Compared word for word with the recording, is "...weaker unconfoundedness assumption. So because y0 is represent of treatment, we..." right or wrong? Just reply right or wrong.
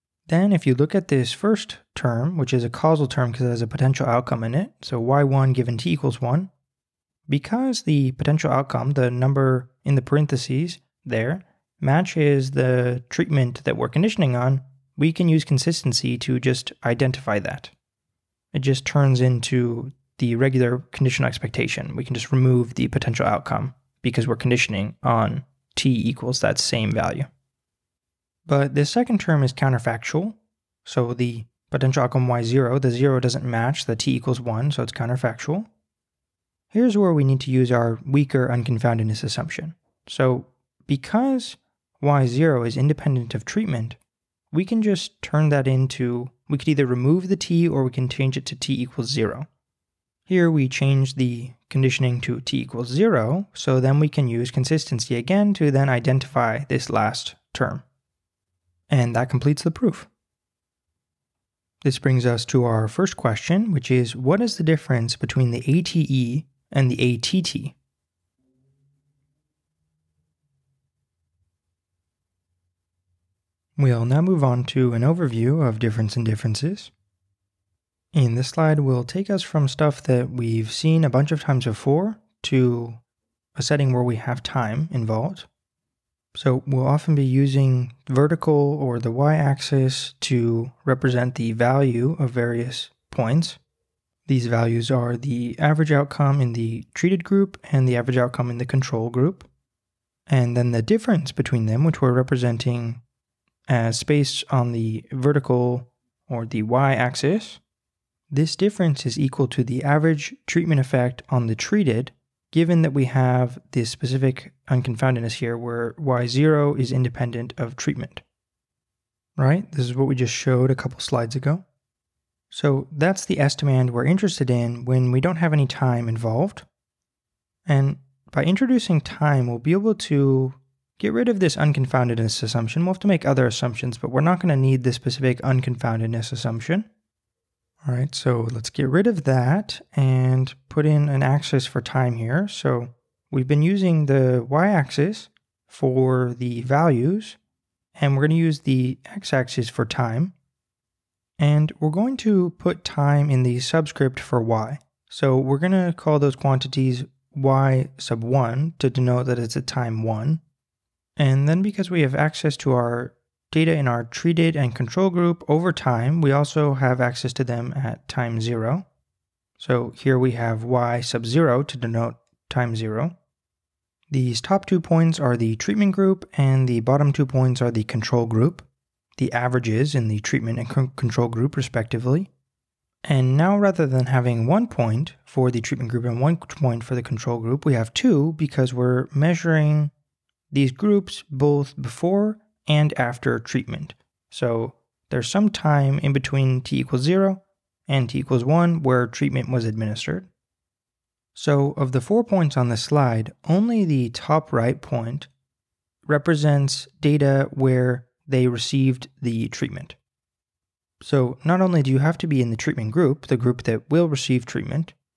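wrong.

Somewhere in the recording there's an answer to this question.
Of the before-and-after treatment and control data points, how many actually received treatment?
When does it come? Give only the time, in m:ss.
3:23.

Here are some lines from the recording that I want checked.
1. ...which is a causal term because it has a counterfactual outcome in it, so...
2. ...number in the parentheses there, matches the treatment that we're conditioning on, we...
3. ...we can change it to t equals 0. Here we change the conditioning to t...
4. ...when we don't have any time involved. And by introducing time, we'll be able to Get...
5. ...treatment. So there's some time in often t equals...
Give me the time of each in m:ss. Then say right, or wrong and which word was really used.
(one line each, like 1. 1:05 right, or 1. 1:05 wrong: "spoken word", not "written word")
1. 0:02 wrong: "potential", not "counterfactual"
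2. 0:09 right
3. 0:47 right
4. 2:04 right
5. 3:13 wrong: "between", not "often".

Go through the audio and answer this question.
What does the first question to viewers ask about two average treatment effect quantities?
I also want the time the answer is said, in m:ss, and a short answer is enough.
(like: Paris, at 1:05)
Difference between the ATE and the ATT, at 1:04.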